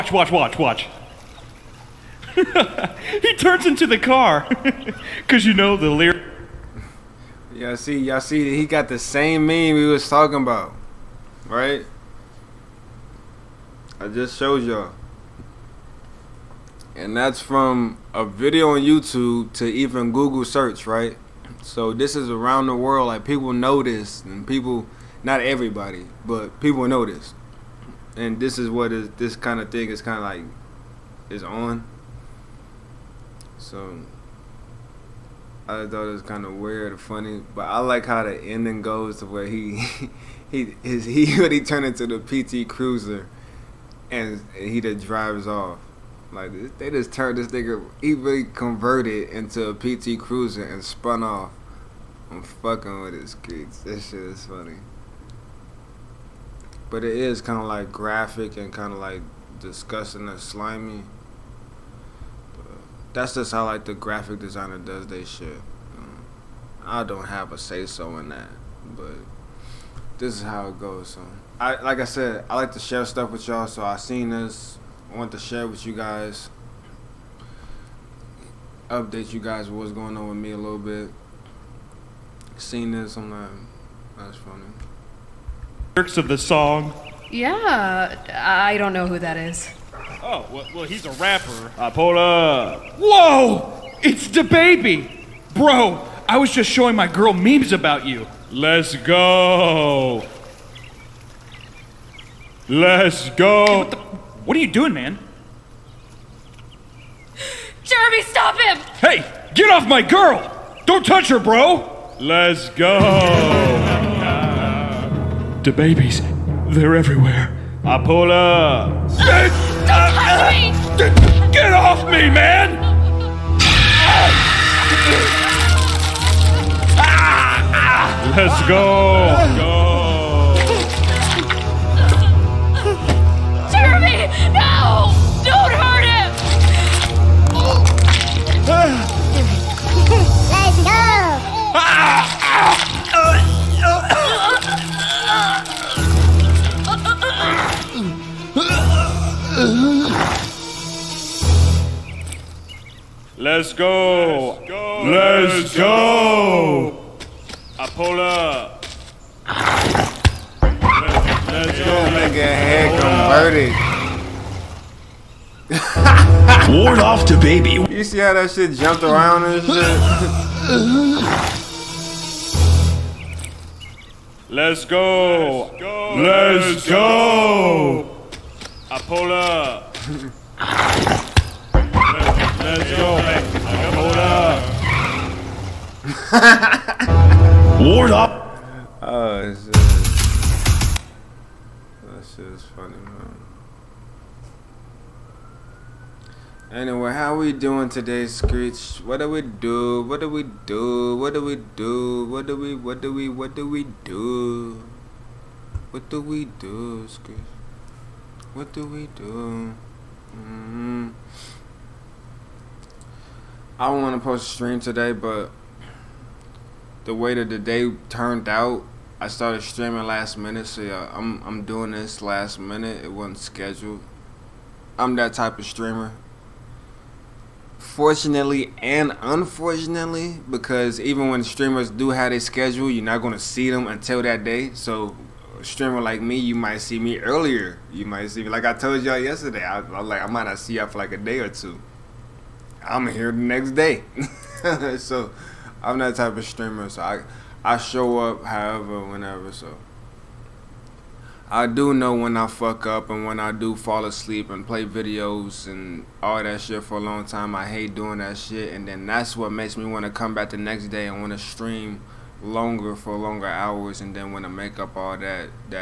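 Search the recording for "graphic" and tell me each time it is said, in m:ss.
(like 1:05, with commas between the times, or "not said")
0:57, 1:03.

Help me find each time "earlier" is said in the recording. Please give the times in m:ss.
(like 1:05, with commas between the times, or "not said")
3:57.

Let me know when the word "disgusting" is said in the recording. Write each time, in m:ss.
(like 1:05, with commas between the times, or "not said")
0:59.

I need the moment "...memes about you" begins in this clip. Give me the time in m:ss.
1:37.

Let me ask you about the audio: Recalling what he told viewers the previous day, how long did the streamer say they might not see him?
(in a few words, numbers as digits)
a day or two.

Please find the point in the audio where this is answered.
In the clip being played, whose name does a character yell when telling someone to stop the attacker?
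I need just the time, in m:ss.
1:47.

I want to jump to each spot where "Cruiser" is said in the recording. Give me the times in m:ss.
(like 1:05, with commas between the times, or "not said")
0:42, 0:50.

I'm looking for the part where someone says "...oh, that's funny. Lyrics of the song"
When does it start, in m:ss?
1:24.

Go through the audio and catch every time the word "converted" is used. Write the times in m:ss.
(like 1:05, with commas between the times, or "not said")
0:48, 2:43.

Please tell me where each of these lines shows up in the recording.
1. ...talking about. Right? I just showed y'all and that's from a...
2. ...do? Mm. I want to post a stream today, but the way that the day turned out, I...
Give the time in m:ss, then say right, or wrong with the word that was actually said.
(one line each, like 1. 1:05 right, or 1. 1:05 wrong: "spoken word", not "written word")
1. 0:10 right
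2. 3:29 right.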